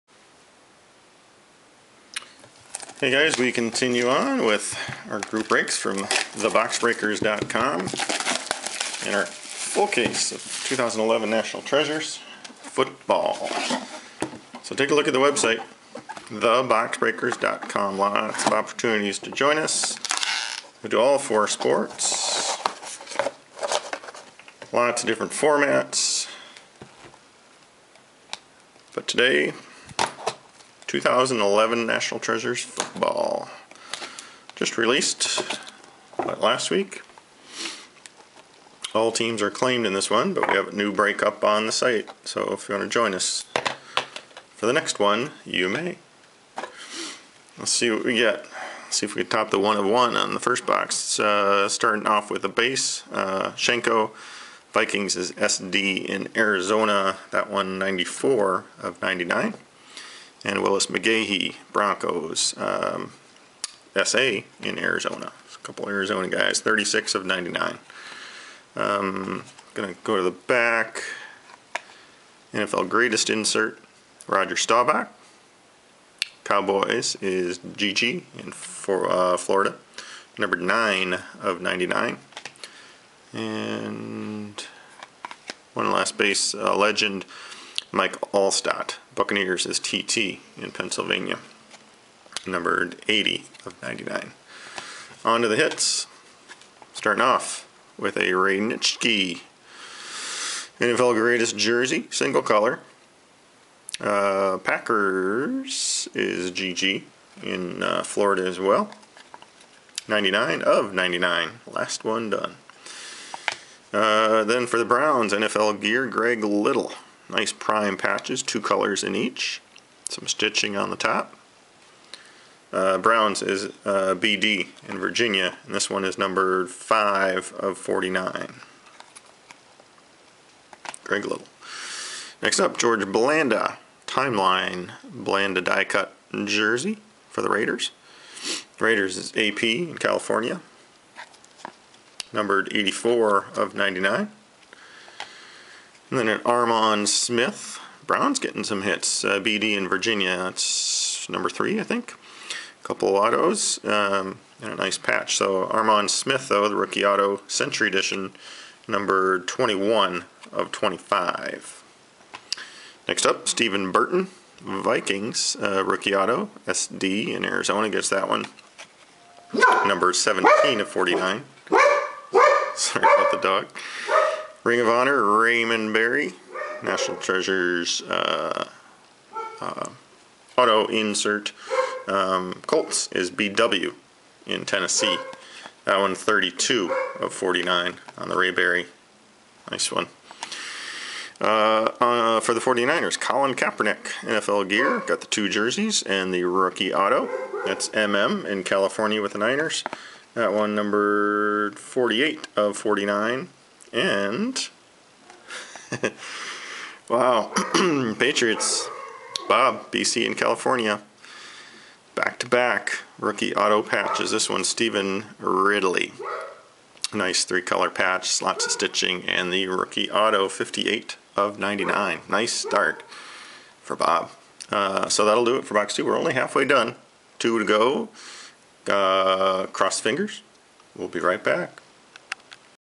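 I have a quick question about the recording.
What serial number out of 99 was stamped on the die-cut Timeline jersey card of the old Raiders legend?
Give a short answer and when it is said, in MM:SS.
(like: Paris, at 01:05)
84, at 02:22.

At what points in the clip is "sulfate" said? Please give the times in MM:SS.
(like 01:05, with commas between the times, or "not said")
not said.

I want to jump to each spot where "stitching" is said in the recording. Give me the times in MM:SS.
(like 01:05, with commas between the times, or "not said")
02:00, 03:38.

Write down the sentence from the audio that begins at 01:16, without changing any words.
Cowboys is GG in for, uh, Florida, number 9 of 99.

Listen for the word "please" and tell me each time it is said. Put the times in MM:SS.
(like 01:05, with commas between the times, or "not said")
not said.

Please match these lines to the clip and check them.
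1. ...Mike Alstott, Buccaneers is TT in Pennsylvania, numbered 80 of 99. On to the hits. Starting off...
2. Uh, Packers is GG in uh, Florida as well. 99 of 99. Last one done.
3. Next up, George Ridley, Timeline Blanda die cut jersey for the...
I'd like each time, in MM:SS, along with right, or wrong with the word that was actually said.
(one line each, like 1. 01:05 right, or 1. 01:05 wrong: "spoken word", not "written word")
1. 01:27 right
2. 01:43 right
3. 02:12 wrong: "Blanda", not "Ridley".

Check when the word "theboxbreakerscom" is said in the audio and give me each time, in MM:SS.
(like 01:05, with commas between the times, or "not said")
00:05, 00:16.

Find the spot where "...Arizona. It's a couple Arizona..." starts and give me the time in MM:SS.
01:04.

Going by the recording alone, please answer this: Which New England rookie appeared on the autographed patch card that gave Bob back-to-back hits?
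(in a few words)
Stephen Ridley.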